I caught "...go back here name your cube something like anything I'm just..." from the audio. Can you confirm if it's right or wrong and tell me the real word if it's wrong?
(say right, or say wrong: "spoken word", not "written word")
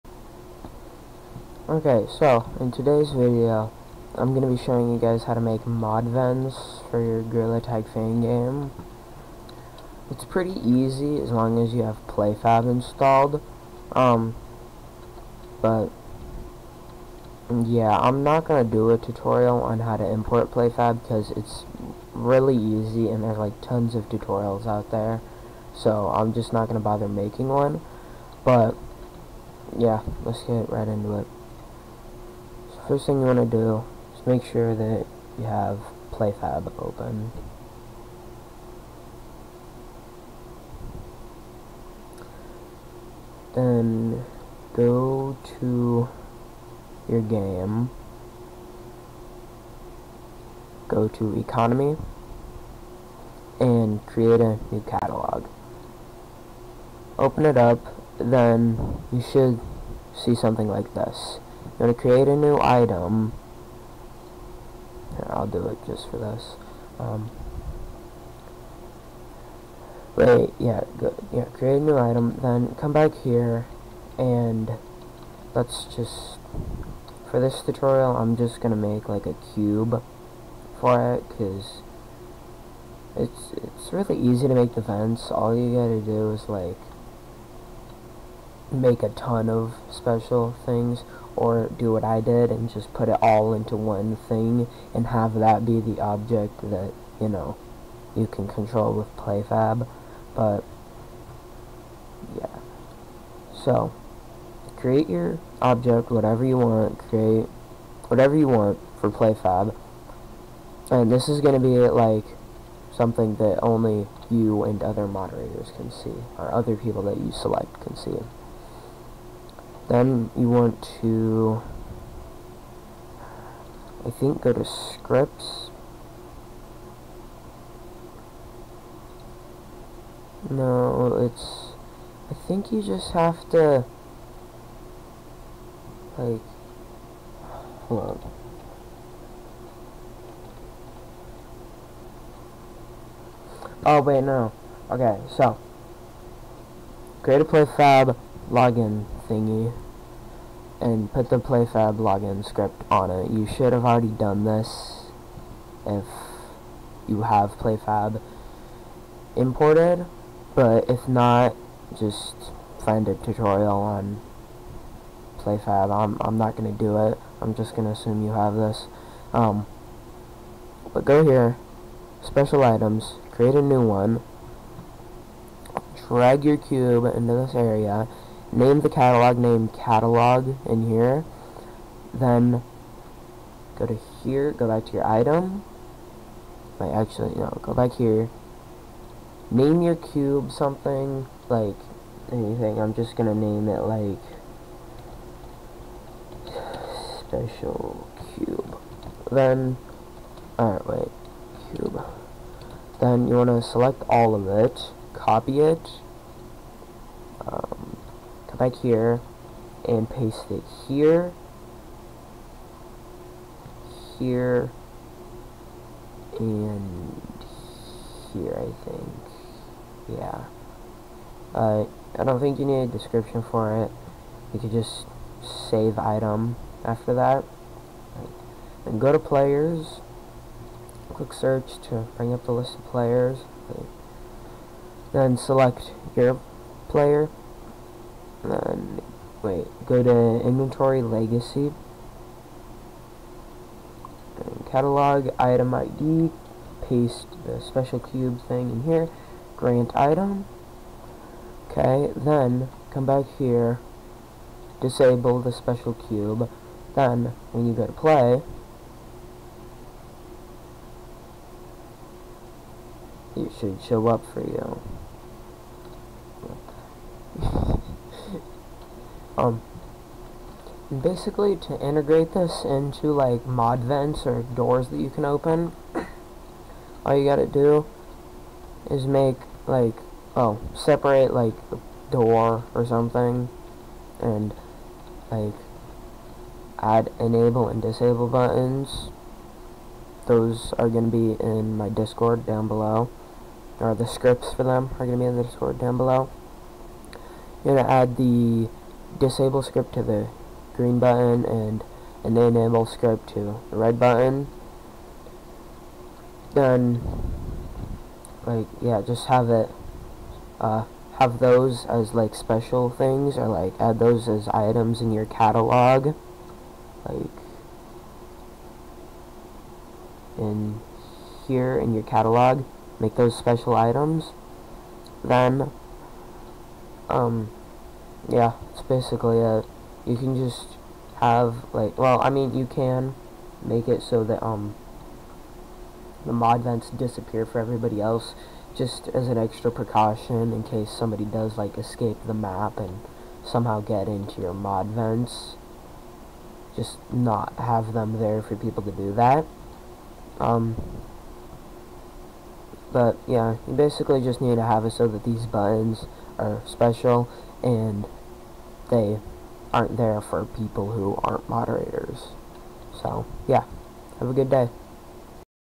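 right.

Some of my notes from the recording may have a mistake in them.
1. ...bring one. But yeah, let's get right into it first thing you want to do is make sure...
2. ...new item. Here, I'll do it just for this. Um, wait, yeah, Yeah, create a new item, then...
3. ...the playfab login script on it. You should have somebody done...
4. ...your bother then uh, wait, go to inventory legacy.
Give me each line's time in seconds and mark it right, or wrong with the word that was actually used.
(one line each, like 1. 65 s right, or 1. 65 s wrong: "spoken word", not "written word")
1. 27 s wrong: "making", not "bring"
2. 62 s right
3. 151 s wrong: "already", not "somebody"
4. 236 s wrong: "player", not "bother".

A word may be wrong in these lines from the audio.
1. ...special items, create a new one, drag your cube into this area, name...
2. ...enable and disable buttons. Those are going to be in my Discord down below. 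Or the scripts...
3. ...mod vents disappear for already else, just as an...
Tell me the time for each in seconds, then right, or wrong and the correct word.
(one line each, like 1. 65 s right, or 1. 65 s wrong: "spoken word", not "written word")
1. 172 s right
2. 287 s right
3. 336 s wrong: "everybody", not "already".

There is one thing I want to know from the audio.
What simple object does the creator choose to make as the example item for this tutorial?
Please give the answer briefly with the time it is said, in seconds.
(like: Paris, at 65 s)
A cube, at 79 s.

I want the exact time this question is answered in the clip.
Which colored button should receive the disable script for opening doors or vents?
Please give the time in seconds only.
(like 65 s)
300 s.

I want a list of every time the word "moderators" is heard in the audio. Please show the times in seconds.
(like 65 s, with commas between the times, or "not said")
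115 s, 361 s.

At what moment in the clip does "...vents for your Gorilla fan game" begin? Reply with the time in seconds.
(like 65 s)
6 s.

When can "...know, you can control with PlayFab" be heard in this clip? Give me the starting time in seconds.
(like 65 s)
97 s.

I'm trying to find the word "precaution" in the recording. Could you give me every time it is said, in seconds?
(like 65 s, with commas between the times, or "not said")
339 s.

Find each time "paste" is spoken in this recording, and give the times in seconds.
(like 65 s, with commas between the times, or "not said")
210 s, 246 s.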